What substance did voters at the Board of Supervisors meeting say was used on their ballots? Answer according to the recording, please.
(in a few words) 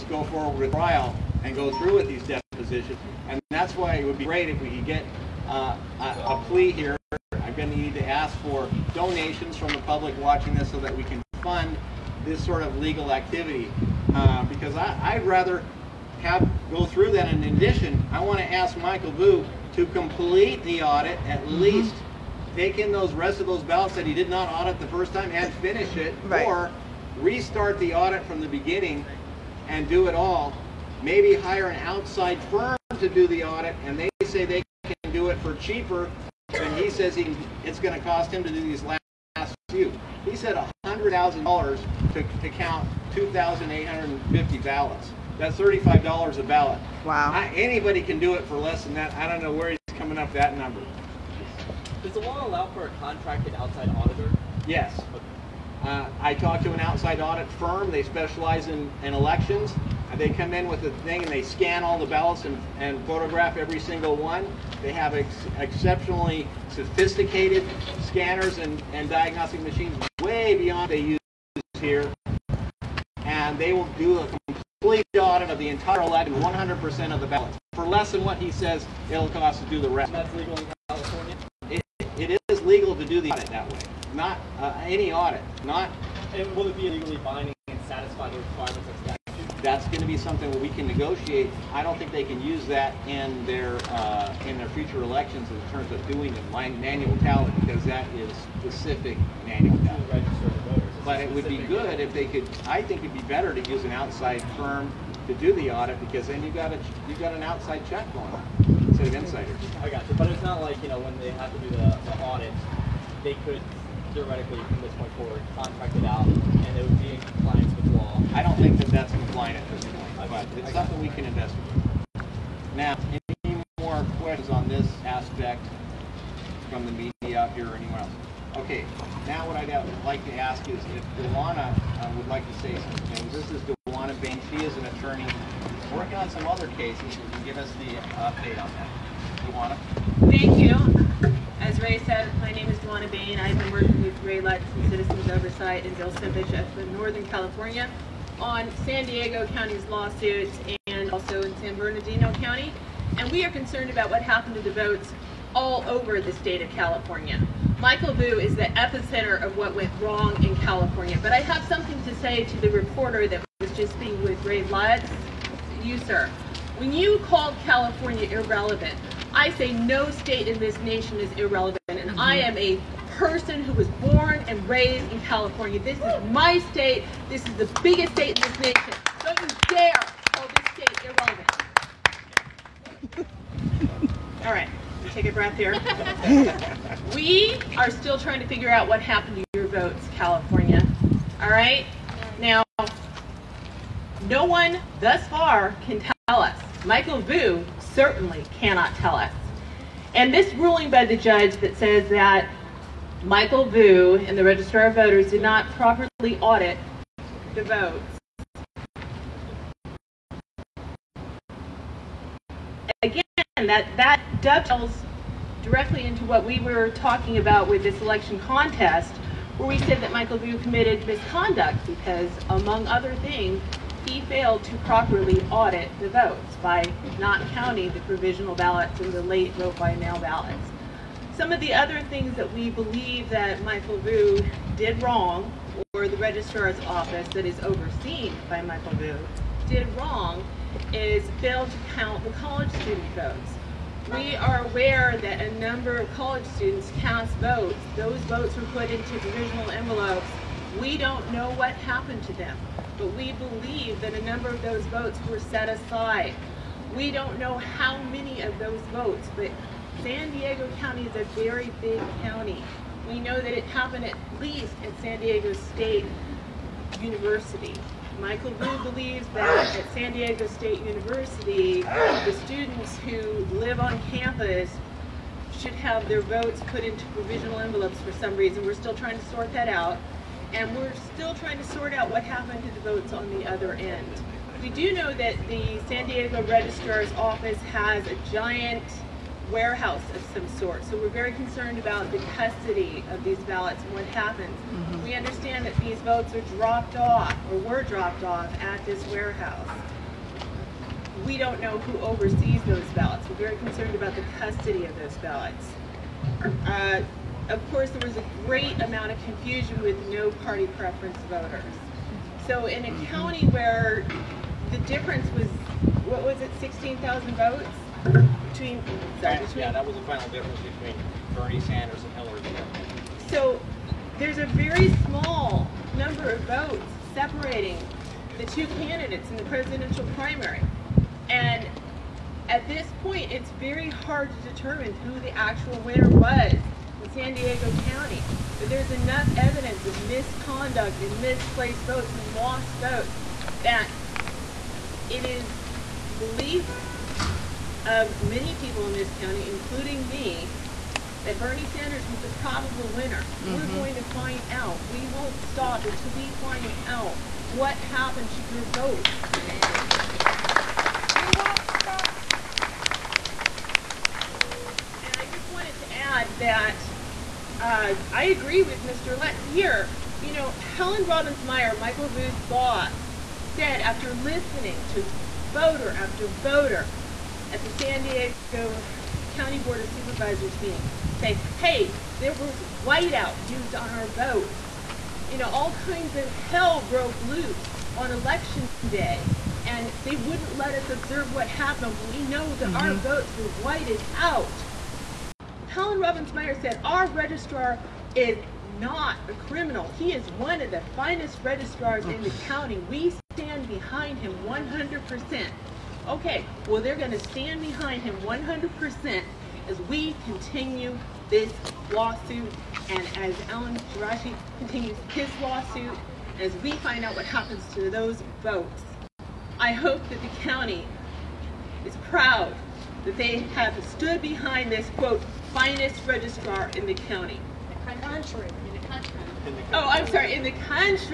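whiteout.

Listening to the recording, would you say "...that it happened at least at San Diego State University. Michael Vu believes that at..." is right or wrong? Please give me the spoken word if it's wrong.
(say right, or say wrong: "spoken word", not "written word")
right.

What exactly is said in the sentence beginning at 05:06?
Uh, of course, there was a great amount of confusion with no party preference voters.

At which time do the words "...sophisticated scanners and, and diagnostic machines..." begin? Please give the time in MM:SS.
01:06.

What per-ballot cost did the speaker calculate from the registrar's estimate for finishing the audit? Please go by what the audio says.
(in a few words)
$35.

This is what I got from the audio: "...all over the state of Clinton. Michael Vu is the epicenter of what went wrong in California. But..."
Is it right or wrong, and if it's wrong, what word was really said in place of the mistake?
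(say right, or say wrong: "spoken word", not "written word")
wrong: "California", not "Clinton".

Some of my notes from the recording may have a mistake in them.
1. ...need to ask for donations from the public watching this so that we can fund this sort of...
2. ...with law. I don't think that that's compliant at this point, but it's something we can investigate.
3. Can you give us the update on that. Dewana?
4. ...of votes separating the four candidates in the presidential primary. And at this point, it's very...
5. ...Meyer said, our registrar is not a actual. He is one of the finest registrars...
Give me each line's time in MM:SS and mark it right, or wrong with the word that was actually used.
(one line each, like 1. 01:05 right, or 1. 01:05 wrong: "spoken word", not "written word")
1. 00:07 right
2. 01:57 right
3. 02:17 right
4. 05:26 wrong: "two", not "four"
5. 06:36 wrong: "criminal", not "actual".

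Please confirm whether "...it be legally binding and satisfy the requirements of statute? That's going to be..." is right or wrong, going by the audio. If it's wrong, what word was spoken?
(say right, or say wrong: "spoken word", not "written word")
right.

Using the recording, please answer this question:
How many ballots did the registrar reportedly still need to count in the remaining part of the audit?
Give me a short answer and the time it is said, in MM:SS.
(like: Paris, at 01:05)
2,850, at 00:43.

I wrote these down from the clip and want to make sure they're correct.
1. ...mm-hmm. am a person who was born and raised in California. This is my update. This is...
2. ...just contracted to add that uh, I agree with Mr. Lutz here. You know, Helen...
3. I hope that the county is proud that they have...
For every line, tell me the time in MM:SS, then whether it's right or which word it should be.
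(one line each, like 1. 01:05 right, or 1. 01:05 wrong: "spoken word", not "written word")
1. 02:52 wrong: "state", not "update"
2. 06:05 wrong: "wanted", not "contracted"
3. 06:59 right.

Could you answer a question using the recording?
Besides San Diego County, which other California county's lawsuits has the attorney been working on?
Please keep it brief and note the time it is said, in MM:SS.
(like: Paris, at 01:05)
San Bernardino County, at 02:31.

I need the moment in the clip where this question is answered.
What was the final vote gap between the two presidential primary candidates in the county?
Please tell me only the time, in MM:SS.
05:16.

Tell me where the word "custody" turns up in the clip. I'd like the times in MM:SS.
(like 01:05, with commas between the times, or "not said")
04:52, 05:04.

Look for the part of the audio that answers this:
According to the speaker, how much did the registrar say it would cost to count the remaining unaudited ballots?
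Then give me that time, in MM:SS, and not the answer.
00:40.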